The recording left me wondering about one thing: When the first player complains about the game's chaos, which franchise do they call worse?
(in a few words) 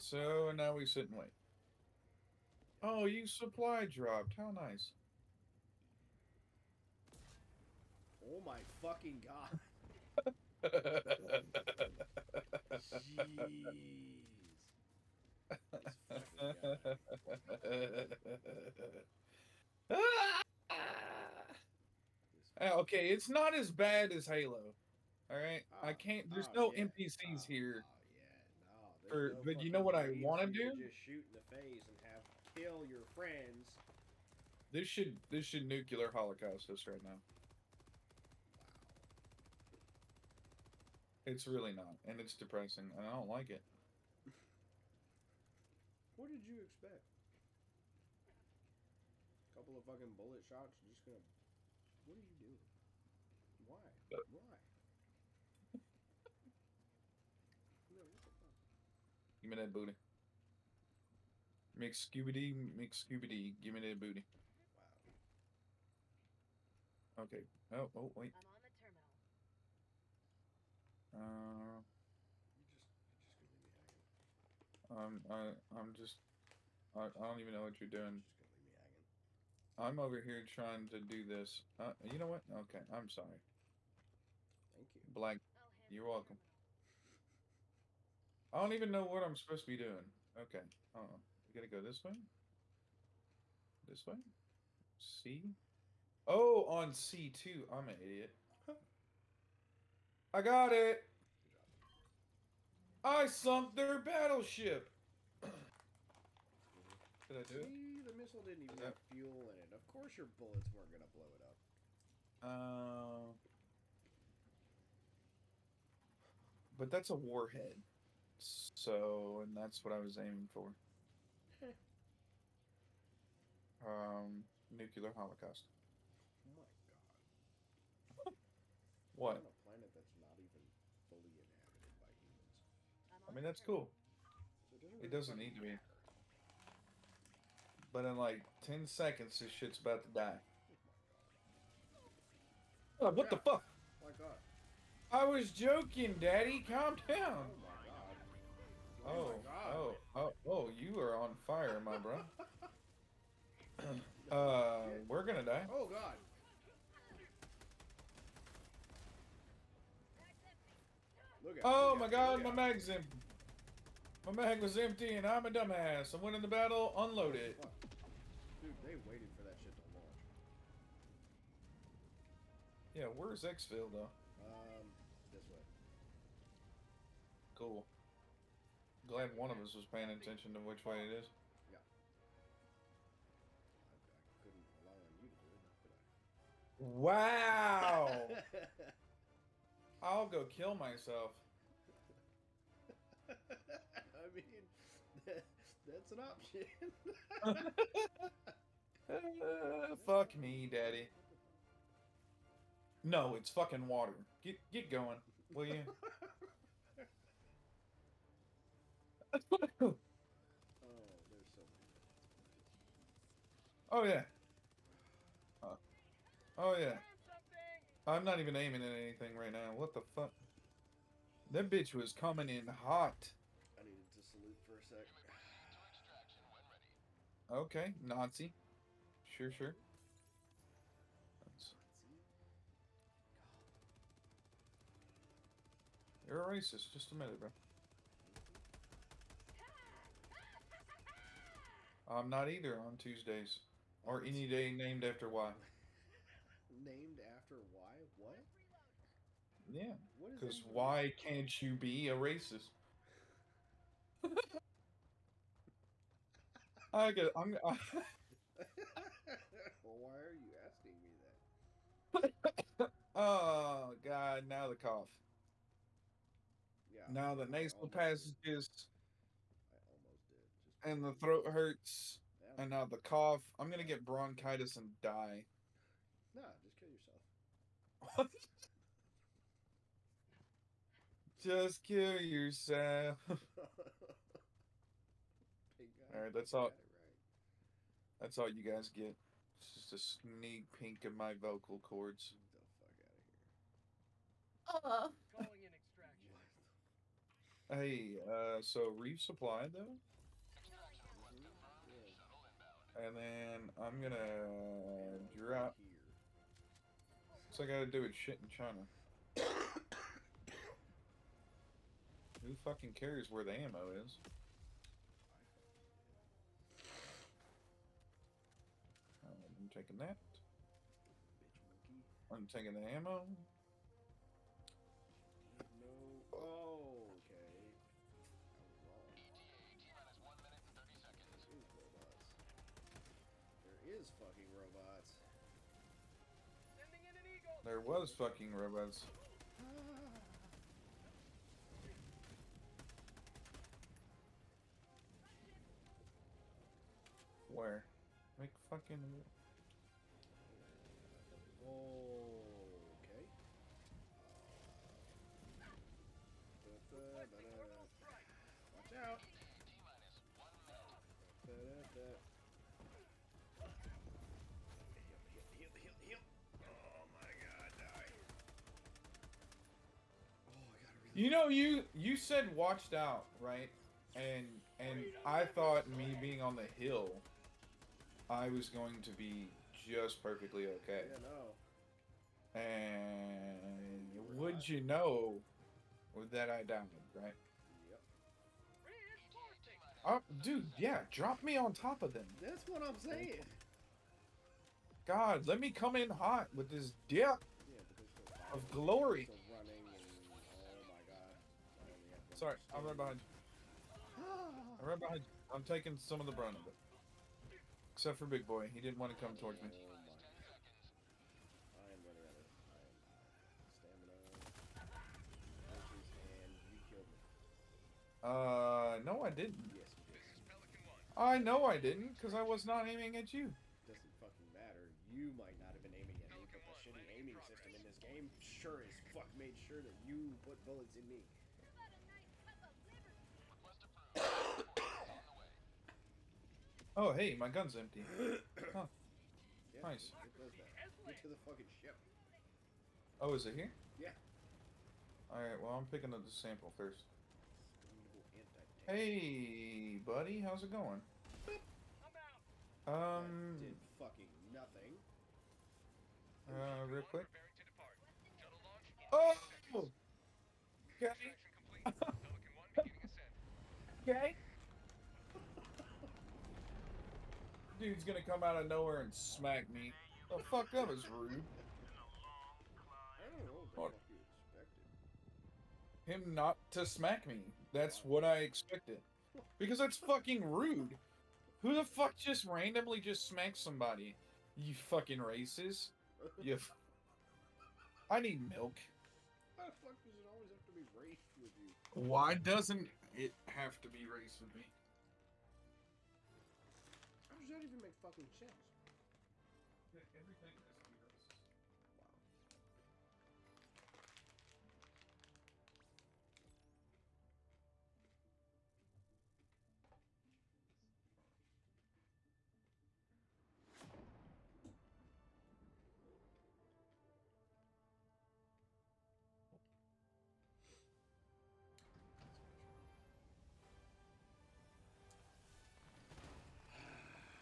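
Halo.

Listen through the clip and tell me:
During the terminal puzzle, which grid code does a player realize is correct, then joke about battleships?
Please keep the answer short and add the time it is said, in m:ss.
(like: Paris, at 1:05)
C2, at 1:36.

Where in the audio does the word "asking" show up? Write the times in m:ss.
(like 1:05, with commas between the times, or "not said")
4:20.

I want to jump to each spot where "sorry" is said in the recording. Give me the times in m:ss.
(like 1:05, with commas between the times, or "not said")
1:23, 6:42.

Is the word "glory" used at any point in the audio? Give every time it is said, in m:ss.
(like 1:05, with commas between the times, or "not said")
6:38.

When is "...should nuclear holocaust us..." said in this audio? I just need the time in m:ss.
0:35.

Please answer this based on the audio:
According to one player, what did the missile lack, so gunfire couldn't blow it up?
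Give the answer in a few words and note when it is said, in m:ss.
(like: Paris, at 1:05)
fuel, at 1:49.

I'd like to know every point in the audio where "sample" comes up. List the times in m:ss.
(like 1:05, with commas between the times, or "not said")
7:26.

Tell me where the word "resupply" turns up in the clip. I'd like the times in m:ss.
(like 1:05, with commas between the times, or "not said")
4:58.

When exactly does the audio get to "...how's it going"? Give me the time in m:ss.
7:30.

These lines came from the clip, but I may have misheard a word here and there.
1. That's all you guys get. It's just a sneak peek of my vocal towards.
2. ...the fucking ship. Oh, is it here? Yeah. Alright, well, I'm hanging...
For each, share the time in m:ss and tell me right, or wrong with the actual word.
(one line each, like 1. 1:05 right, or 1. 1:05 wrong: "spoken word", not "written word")
1. 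4:48 wrong: "cords", not "towards"
2. 7:21 wrong: "picking", not "hanging".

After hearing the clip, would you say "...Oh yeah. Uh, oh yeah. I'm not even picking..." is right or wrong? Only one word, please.
wrong.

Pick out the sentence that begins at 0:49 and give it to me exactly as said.
A couple of fucking bullet shots, just gonna.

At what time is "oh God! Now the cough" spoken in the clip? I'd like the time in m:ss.
4:23.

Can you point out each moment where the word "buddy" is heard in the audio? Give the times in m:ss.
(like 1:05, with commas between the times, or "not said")
7:29.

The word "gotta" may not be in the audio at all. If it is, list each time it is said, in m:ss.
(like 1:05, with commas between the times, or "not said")
1:31, 5:07.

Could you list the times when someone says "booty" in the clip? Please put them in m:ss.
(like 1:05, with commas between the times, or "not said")
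0:59, 1:03.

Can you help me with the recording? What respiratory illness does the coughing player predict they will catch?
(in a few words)
bronchitis.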